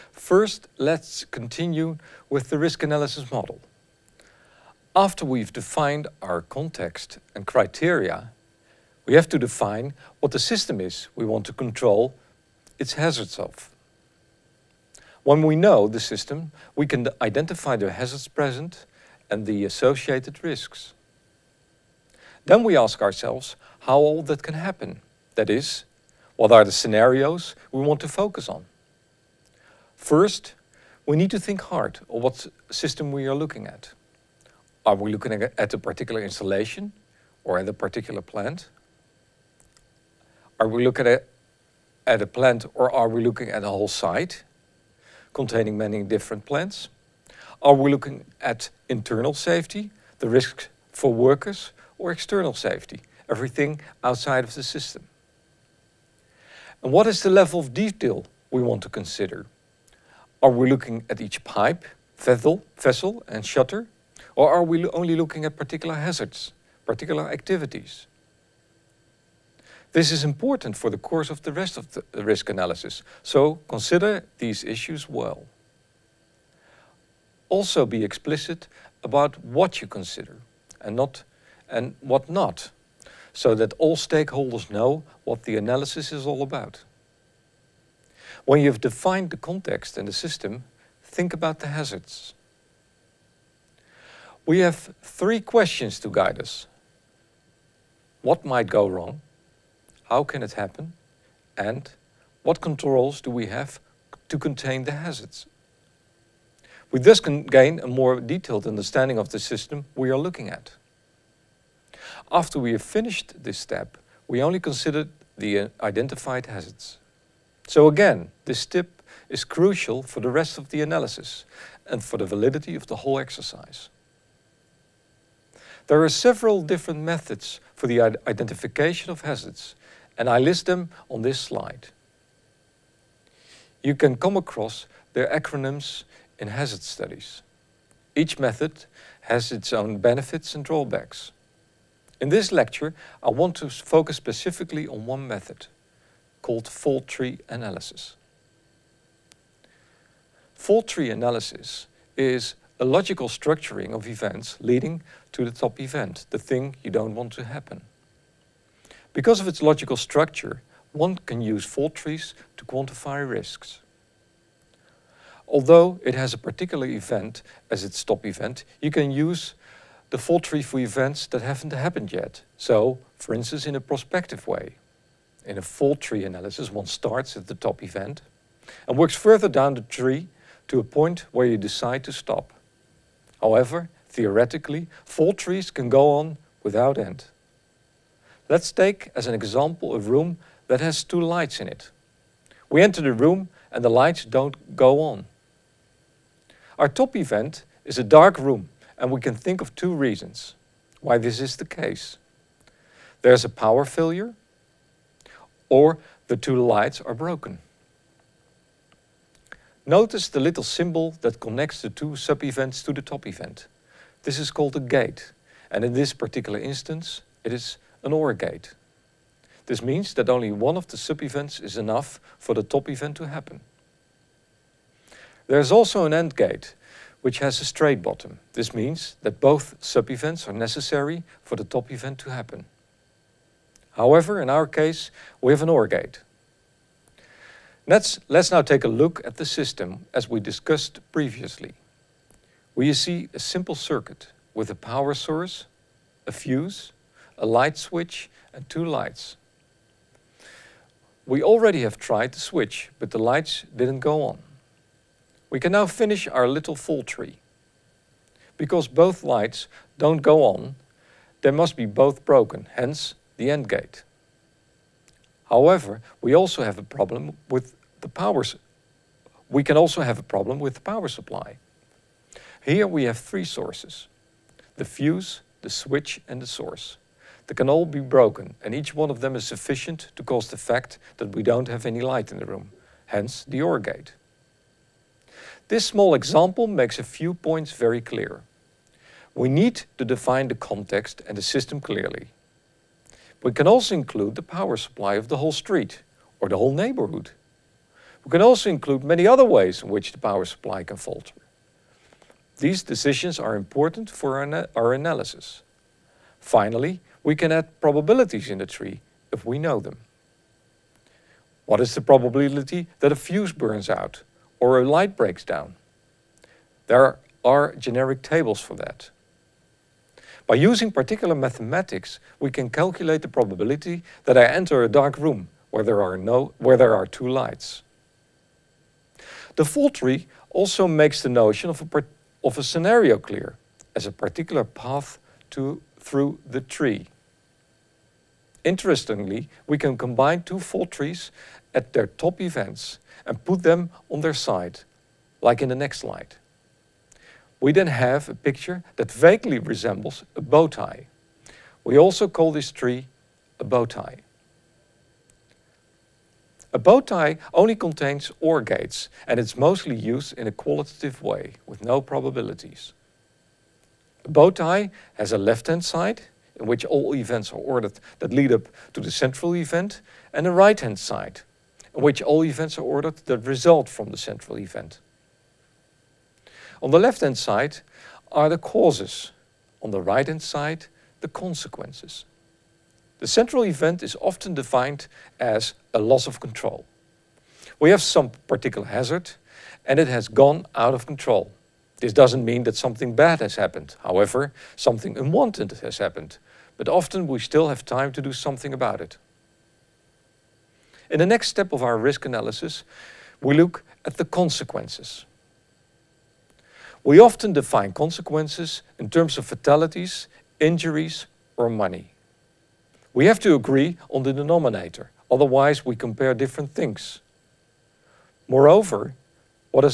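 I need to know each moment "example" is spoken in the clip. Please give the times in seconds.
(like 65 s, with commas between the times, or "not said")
189 s, 286 s.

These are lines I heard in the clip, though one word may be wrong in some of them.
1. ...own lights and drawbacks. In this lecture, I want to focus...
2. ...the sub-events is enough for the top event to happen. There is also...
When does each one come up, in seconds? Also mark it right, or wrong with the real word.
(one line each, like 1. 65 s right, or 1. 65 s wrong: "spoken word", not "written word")
1. 139 s wrong: "benefits", not "lights"
2. 220 s right.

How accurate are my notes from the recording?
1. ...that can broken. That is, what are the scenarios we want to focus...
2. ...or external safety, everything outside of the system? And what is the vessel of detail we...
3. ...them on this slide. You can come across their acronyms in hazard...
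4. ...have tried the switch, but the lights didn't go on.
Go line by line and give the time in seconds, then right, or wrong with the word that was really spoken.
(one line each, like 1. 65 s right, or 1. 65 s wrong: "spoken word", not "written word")
1. 24 s wrong: "happen", not "broken"
2. 51 s wrong: "level", not "vessel"
3. 130 s right
4. 251 s right.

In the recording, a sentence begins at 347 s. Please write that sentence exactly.
We then have a picture that vaguely resembles a bow tie.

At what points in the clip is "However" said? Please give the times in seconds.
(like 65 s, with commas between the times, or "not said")
183 s, 233 s, 265 s, 394 s.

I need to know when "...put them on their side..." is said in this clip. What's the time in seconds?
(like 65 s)
343 s.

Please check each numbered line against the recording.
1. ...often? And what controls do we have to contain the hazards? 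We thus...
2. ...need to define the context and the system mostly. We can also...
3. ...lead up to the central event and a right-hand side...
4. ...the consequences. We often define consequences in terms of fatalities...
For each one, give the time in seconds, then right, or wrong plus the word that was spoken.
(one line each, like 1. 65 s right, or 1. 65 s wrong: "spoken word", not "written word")
1. 100 s wrong: "happen", not "often"
2. 289 s wrong: "clearly", not "mostly"
3. 368 s right
4. 404 s right.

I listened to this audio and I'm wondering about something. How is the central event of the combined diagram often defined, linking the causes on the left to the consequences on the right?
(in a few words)
a loss of control.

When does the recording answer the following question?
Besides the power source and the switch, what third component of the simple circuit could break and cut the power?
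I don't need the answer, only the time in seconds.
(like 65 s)
274 s.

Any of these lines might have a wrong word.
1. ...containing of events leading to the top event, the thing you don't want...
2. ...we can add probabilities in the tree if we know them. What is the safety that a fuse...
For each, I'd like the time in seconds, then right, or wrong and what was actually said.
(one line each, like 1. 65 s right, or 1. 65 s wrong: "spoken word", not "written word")
1. 153 s wrong: "structuring", not "containing"
2. 307 s wrong: "probability", not "safety".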